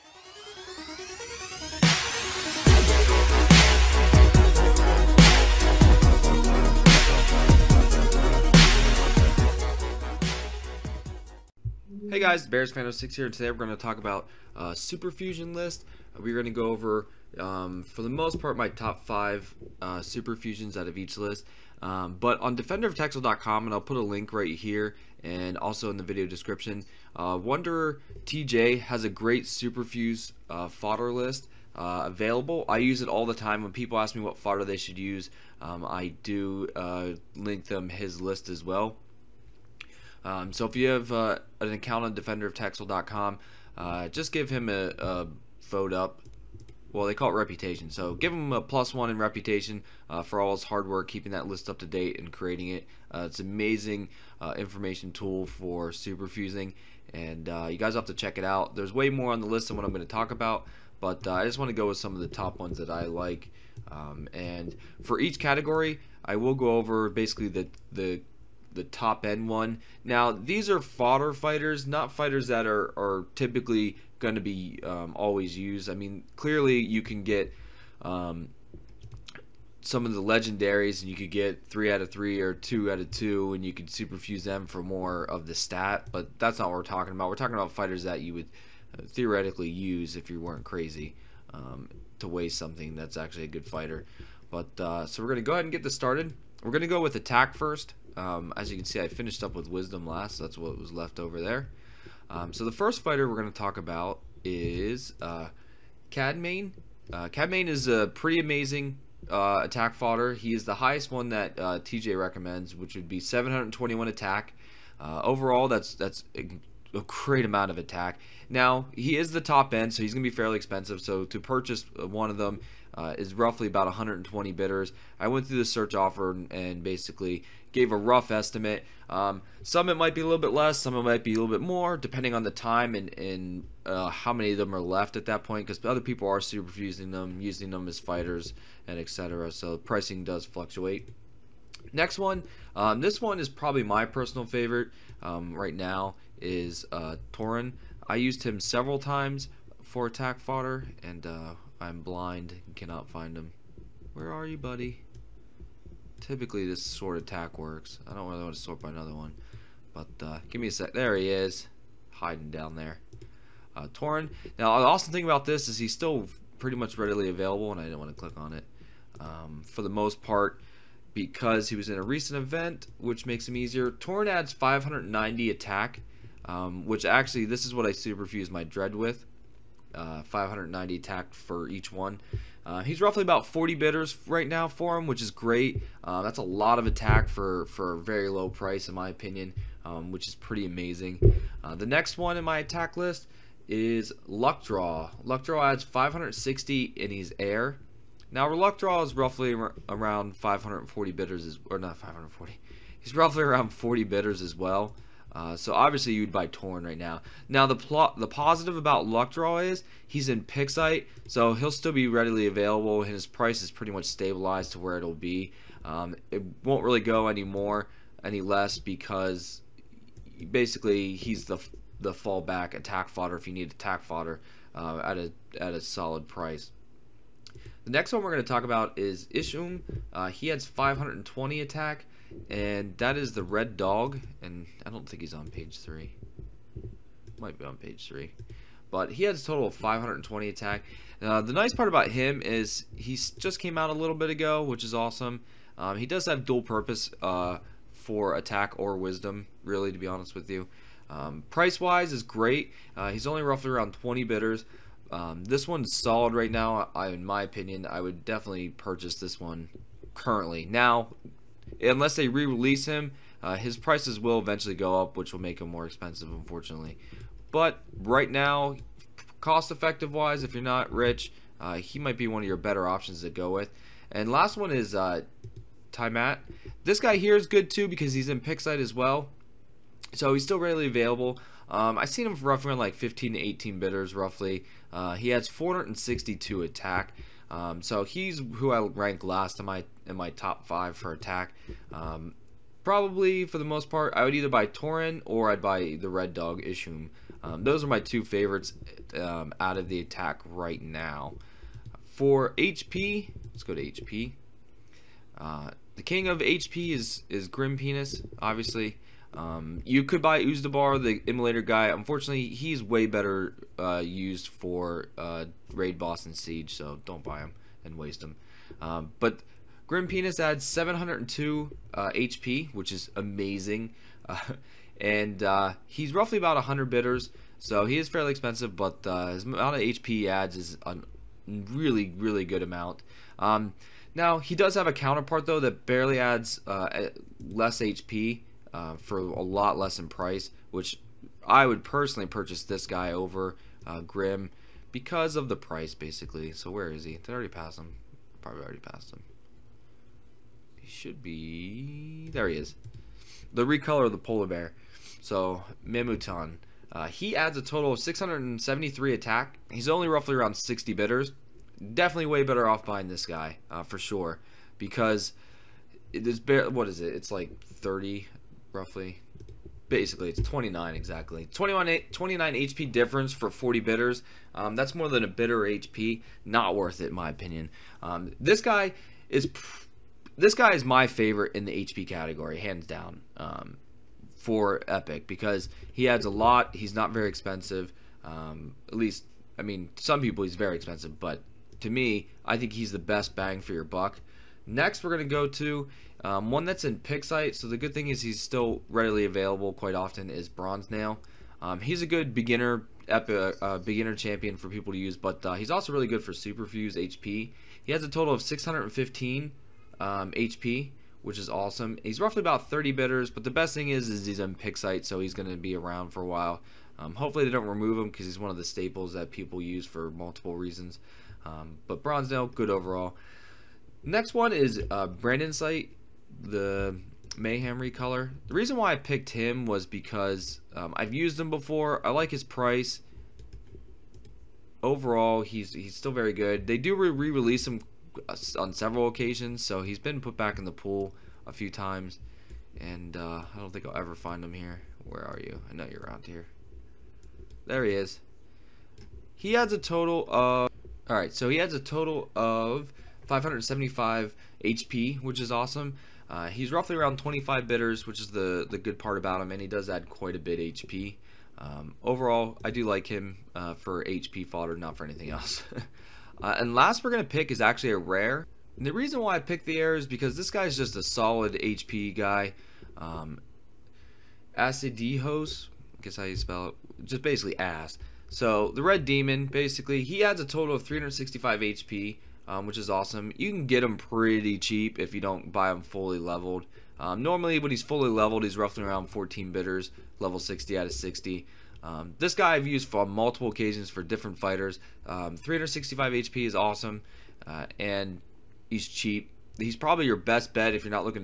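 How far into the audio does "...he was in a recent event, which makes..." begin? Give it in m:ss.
2:51.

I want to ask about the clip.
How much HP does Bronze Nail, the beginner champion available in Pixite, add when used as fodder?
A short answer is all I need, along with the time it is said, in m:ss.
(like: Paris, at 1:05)
615, at 6:48.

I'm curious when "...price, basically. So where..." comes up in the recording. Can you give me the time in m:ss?
5:45.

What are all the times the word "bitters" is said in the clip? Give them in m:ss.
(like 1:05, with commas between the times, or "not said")
5:26, 6:52, 7:37.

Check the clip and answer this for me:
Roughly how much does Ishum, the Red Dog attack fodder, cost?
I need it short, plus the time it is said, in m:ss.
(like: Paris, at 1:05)
About 20 bidders, at 4:13.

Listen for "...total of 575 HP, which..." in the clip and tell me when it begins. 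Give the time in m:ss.
7:31.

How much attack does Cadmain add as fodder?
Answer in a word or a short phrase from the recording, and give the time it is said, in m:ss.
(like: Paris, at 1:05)
721, at 1:53.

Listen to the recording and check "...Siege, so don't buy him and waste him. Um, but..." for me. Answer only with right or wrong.
right.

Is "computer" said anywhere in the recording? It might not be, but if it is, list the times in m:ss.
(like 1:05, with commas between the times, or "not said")
not said.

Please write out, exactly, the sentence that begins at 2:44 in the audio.
Now, the awesome thing about this is he's still pretty much readily available, and I didn't want to click on it.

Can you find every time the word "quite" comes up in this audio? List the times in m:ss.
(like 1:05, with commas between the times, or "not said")
6:39, 7:40.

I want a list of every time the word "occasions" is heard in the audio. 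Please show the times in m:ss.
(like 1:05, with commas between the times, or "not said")
7:19, 8:13.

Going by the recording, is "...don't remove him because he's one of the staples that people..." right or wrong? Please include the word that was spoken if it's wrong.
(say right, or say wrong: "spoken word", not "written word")
right.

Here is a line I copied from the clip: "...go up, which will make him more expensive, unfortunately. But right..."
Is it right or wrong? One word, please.
right.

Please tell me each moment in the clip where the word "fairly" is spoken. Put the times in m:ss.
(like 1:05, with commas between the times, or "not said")
2:00, 5:28.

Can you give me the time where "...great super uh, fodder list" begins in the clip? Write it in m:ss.
0:29.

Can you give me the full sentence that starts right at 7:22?
And uh, I don't think I'll ever find him here.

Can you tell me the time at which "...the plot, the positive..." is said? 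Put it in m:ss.
3:27.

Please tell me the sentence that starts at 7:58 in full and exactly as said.
So the Red Demon, basically, he adds a total of 365 HP um, which is awesome.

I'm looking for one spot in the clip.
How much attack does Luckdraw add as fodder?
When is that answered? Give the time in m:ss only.
3:15.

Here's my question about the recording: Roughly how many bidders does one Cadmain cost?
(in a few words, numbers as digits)
About 120.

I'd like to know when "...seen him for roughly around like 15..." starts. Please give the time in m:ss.
4:42.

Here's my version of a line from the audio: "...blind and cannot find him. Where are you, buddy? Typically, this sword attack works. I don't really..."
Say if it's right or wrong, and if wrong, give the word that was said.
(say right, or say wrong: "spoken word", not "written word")
right.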